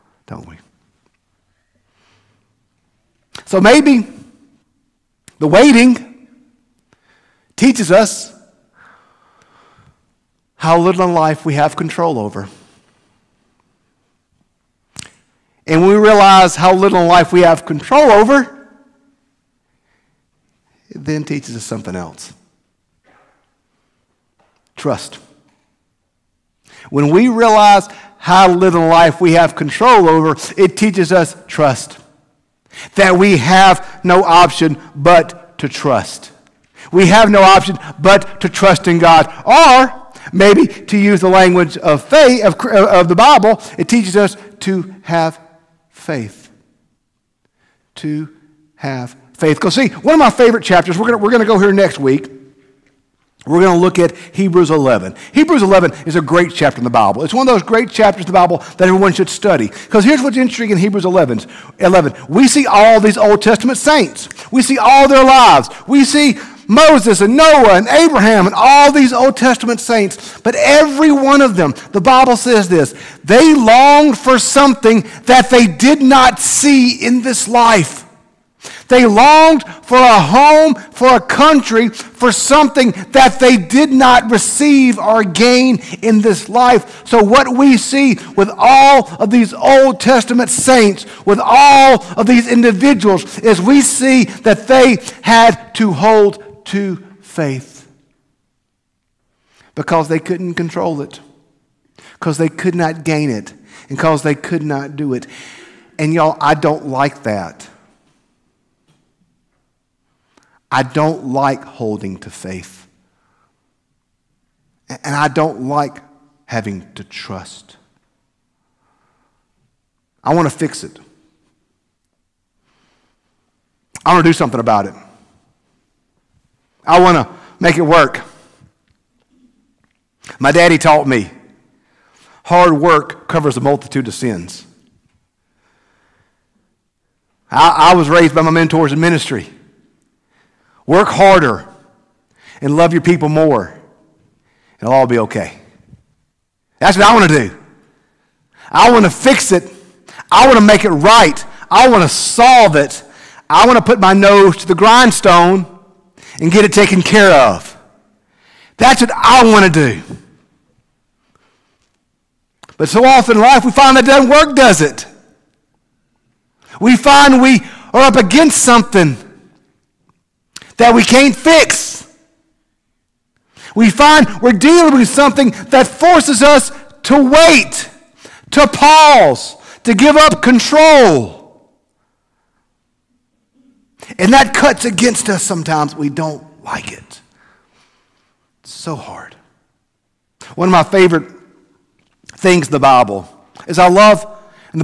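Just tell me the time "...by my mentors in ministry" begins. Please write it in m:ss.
2:18.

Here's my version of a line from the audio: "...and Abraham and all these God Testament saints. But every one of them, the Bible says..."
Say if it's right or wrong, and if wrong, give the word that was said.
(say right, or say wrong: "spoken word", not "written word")
wrong: "Old", not "God".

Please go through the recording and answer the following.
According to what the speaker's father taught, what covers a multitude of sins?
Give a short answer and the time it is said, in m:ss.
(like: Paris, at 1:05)
Hard work, at 2:12.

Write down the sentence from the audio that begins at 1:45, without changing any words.
And y'all, I don't like that.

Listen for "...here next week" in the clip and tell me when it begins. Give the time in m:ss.
0:51.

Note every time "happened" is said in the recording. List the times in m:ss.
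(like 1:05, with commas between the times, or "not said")
not said.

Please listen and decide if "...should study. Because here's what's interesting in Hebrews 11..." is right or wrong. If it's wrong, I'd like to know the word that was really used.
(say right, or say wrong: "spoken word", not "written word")
right.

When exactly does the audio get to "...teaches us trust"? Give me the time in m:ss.
0:30.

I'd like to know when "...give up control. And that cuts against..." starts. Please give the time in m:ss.
2:59.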